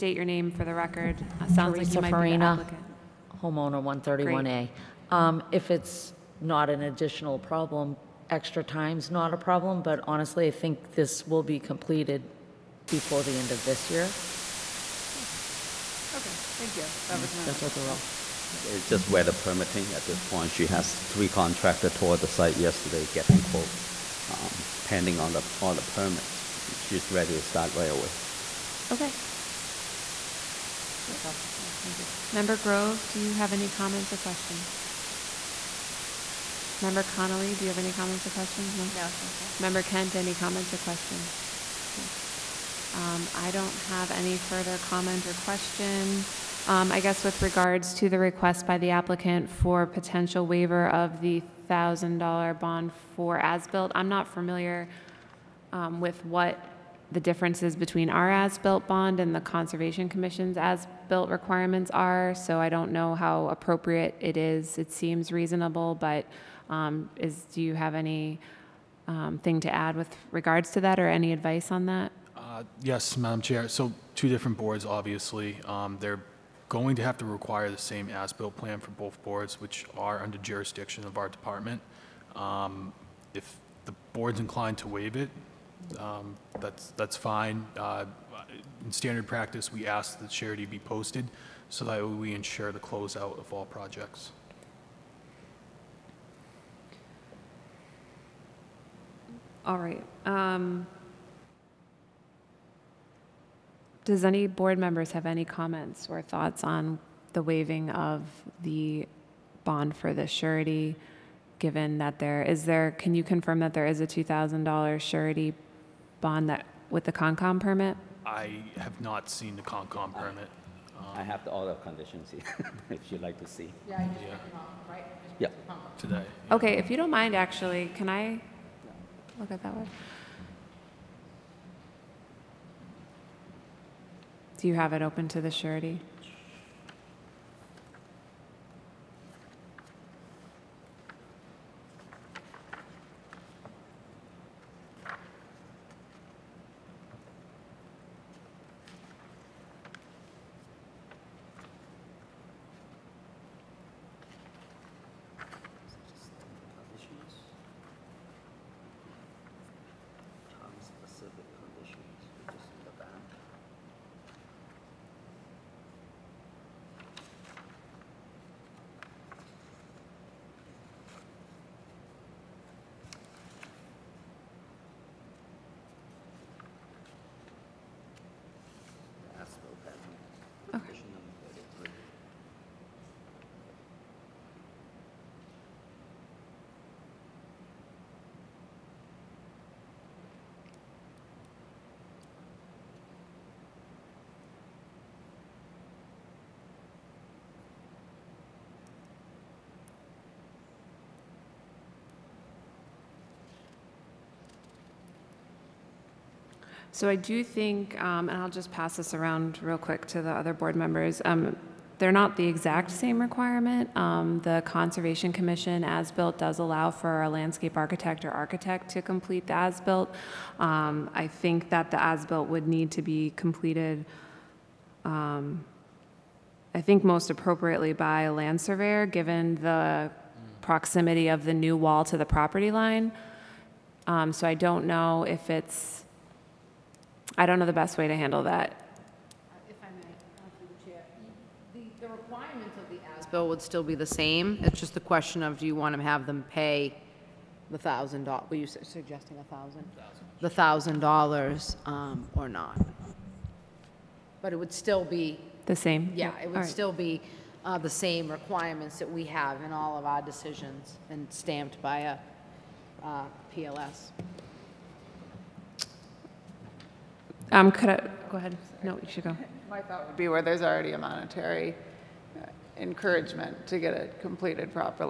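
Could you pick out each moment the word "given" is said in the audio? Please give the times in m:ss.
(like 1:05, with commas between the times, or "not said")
1:51, 3:49.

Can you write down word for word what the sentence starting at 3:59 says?
If I may, the the, requirements of the as-built would still be the same.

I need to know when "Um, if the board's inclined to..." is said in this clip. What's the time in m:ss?
1:22.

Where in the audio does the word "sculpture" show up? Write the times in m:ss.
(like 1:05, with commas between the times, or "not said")
not said.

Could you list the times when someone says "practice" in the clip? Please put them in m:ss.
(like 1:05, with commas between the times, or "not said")
1:29.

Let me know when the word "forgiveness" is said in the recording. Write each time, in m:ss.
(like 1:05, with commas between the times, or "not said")
not said.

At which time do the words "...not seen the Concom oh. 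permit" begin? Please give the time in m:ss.
1:59.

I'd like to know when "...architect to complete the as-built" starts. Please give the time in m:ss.
3:38.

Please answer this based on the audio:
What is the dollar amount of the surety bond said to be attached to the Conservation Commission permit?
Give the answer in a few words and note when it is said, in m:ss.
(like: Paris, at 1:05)
$2,000, at 1:54.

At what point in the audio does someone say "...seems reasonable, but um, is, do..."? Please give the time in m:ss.
1:04.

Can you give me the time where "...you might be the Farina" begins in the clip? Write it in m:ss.
0:01.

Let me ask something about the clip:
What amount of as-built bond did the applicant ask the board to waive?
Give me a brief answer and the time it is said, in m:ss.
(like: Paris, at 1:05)
$1,000, at 0:51.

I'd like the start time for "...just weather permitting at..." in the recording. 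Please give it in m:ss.
0:18.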